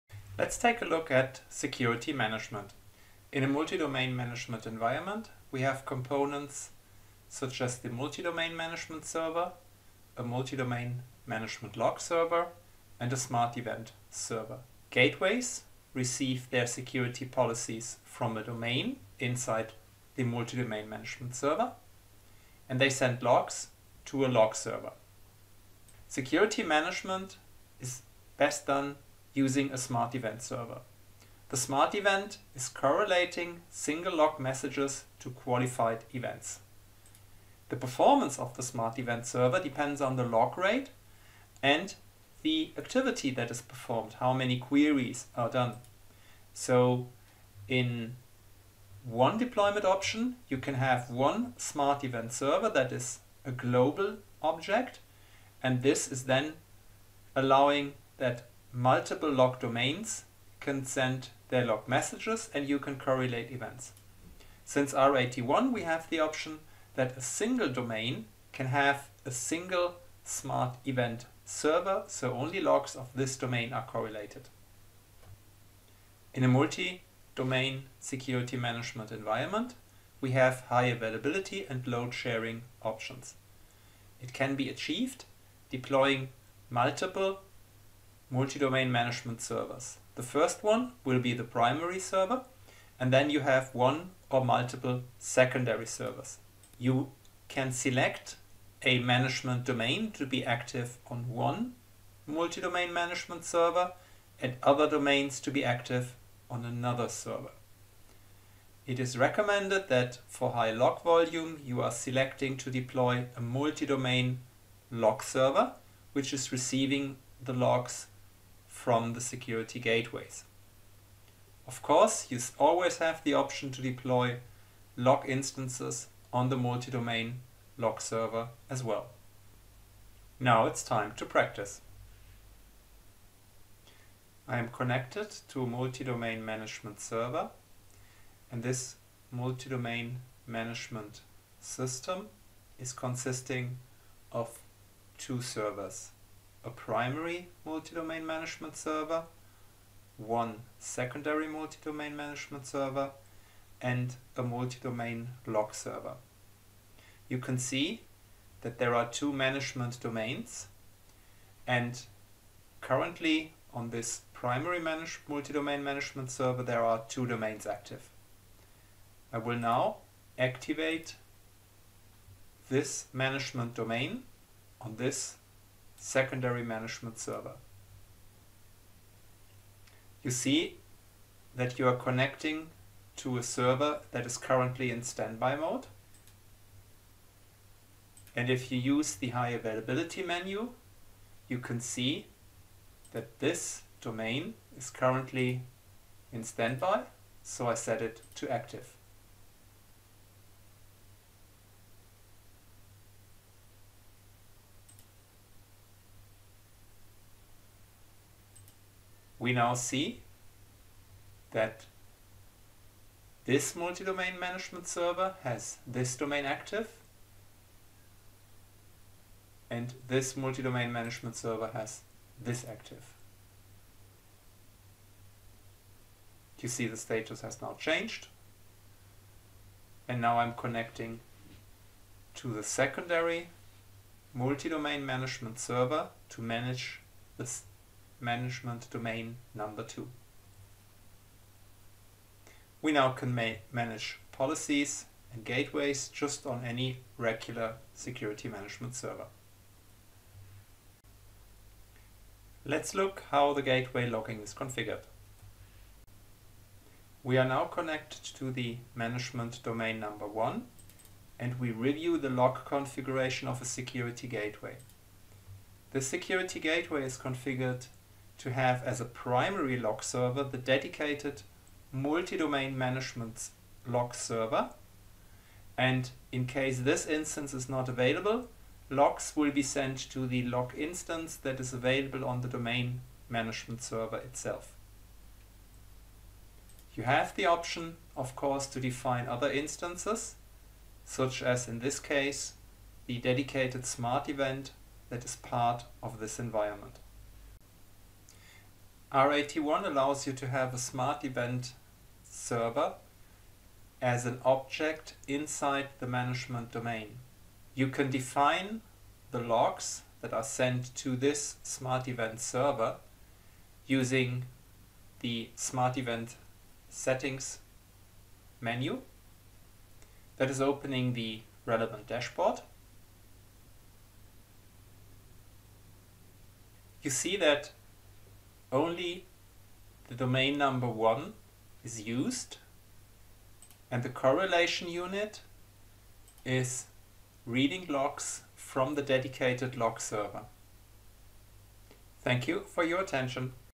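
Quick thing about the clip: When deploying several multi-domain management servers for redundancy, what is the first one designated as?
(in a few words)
Primary server.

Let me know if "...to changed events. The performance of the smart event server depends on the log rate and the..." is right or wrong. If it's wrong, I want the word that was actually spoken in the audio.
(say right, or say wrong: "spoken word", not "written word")
wrong: "qualified", not "changed".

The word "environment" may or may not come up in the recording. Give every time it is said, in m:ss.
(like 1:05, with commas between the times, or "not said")
0:04, 1:19, 4:56.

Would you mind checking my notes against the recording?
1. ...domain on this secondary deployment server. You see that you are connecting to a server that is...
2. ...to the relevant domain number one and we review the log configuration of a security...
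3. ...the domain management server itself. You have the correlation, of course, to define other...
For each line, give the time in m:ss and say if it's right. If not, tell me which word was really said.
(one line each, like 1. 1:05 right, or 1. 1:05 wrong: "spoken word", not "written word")
1. 2:53 wrong: "management", not "deployment"
2. 4:18 wrong: "management", not "relevant"
3. 4:42 wrong: "option", not "correlation".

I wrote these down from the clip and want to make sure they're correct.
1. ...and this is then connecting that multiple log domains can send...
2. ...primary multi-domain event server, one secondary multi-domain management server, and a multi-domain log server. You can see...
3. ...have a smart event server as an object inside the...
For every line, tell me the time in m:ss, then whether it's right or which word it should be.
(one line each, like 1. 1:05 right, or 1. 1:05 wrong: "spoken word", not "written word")
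1. 0:55 wrong: "allowing", not "connecting"
2. 2:26 wrong: "management", not "event"
3. 5:00 right.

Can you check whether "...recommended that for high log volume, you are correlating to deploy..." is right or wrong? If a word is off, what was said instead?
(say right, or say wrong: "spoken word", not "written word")
wrong: "selecting", not "correlating".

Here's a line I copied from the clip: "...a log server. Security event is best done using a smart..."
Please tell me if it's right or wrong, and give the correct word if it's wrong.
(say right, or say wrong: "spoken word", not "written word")
wrong: "management", not "event".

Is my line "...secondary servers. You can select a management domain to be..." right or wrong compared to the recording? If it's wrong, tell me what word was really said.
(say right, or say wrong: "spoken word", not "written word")
right.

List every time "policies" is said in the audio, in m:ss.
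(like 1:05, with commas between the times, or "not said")
0:17, 4:04.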